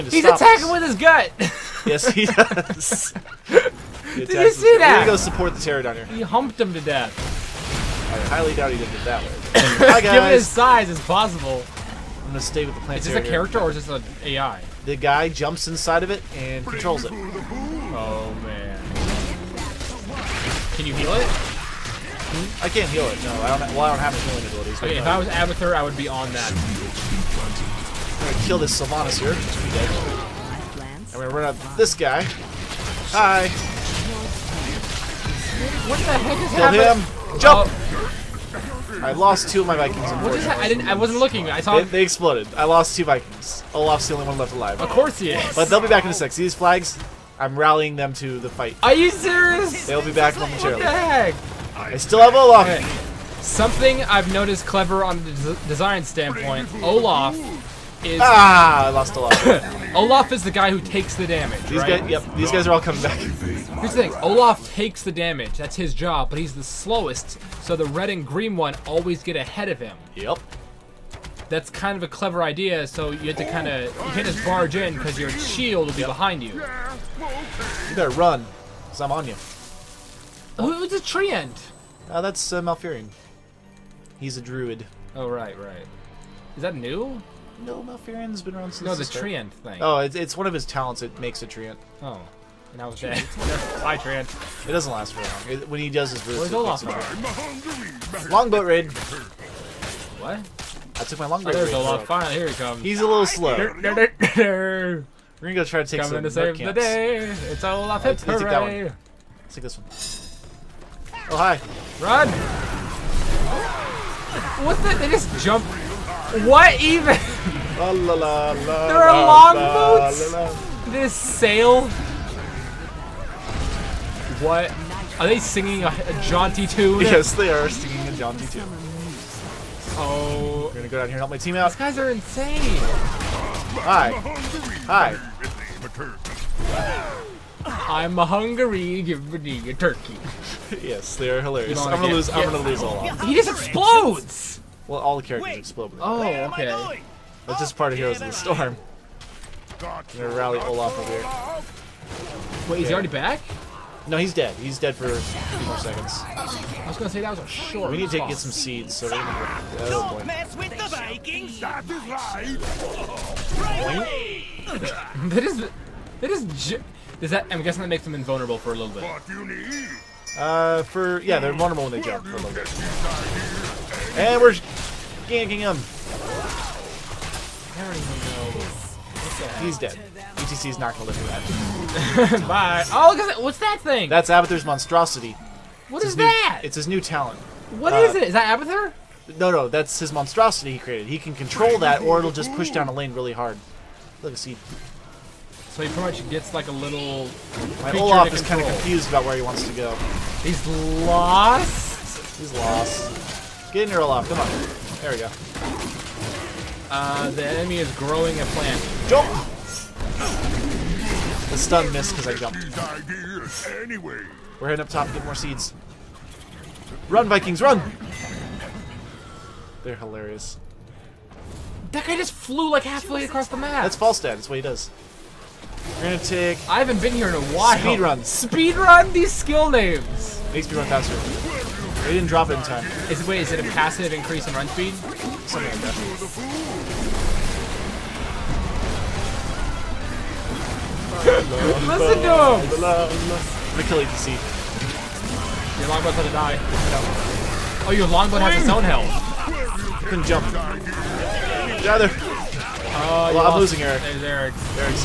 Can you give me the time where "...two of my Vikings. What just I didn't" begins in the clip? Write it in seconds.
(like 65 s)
39 s.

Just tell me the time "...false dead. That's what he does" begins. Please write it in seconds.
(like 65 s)
223 s.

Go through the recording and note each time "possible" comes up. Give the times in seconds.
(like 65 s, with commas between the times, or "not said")
11 s.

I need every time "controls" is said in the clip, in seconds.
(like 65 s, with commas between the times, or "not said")
16 s, 191 s.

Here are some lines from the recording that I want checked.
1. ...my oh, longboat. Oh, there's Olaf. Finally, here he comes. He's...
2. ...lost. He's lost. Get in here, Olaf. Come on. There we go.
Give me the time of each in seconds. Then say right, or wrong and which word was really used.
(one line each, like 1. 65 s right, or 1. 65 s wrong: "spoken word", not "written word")
1. 101 s right
2. 201 s right.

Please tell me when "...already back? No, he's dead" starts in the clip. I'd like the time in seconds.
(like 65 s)
152 s.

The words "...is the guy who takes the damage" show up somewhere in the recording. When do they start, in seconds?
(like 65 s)
60 s.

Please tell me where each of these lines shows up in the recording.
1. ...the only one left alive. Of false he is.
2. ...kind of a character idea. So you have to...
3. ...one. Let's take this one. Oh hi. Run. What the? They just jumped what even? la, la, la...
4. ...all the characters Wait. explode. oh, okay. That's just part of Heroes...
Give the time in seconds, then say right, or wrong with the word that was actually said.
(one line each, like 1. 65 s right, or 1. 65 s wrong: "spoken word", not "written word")
1. 44 s wrong: "course", not "false"
2. 71 s wrong: "clever", not "character"
3. 108 s right
4. 145 s right.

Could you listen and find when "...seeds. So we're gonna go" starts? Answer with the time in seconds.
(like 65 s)
158 s.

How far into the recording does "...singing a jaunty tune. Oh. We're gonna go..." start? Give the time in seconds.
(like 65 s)
127 s.